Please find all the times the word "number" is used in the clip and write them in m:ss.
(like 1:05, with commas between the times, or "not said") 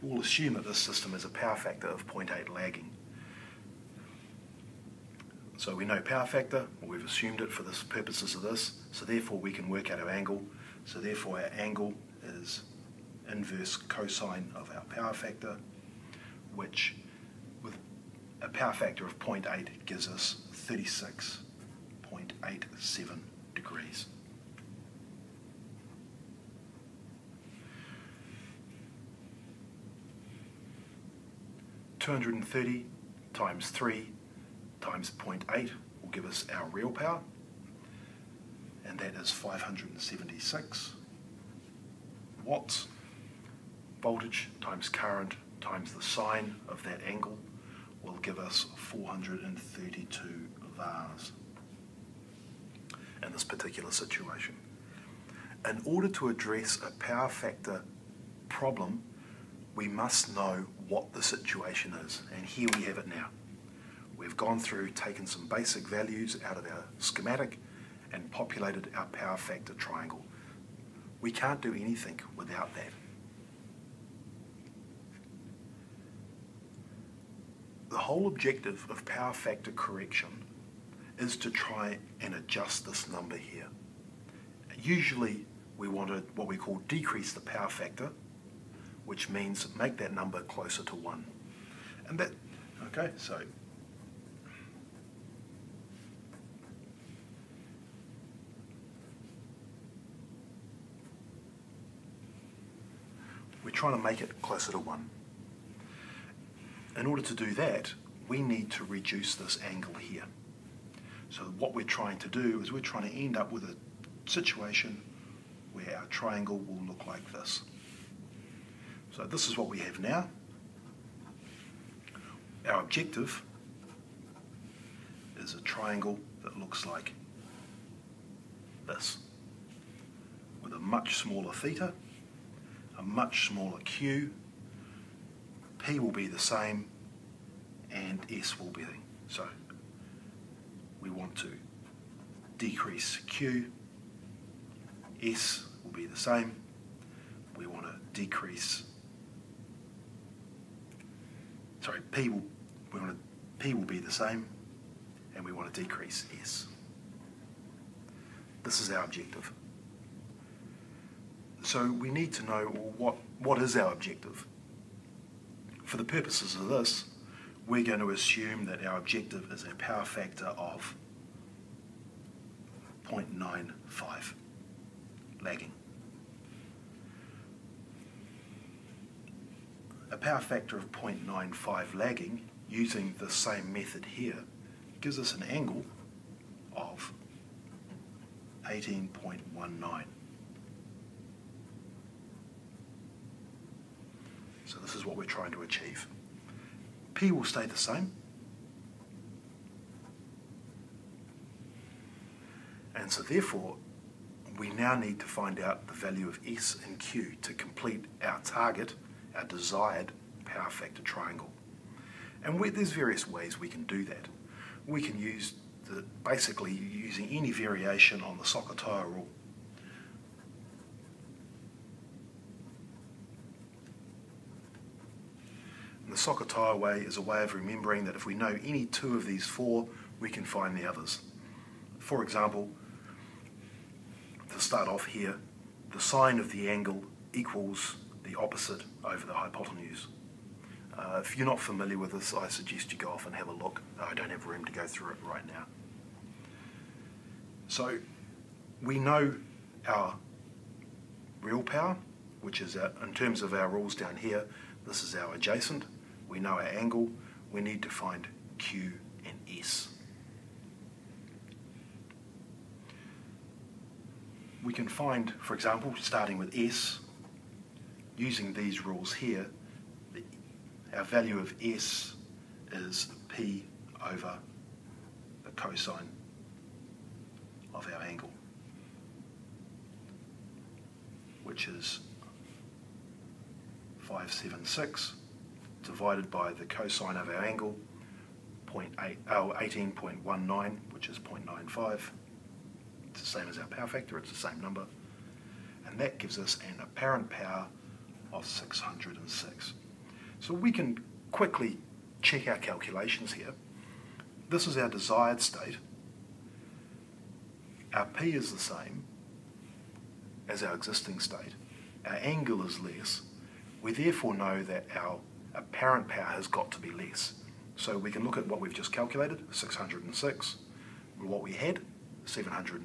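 1:23, 1:30, 4:54.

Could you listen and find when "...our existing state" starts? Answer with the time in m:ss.
5:10.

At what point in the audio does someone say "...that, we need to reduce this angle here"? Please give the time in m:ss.
1:47.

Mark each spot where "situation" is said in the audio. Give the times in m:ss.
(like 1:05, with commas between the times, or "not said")
0:53, 1:01, 1:54.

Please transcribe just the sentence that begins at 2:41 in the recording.
So we need to know well, what, what is our objective.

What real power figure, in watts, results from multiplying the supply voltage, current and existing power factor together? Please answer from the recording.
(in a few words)
576 watts.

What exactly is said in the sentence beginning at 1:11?
We can't do anything without that.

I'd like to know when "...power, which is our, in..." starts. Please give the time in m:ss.
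4:11.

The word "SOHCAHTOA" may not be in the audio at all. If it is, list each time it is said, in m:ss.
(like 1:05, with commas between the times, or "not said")
3:38, 3:46.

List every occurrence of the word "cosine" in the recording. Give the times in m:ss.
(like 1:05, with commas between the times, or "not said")
0:13, 4:35, 4:46.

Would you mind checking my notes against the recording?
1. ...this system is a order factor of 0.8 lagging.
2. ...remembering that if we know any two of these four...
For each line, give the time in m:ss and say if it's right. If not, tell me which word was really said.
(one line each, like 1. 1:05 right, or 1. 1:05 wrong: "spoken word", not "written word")
1. 0:00 wrong: "power", not "order"
2. 3:47 right.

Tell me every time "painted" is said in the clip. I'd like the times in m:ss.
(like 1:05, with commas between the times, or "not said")
not said.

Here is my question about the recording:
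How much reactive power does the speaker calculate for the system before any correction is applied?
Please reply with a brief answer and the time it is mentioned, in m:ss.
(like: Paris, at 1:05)
432 vars, at 0:48.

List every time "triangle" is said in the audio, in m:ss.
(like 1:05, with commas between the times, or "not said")
1:09, 1:56, 2:05, 3:31.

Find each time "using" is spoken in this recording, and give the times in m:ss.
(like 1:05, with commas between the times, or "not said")
3:02, 3:36, 4:28.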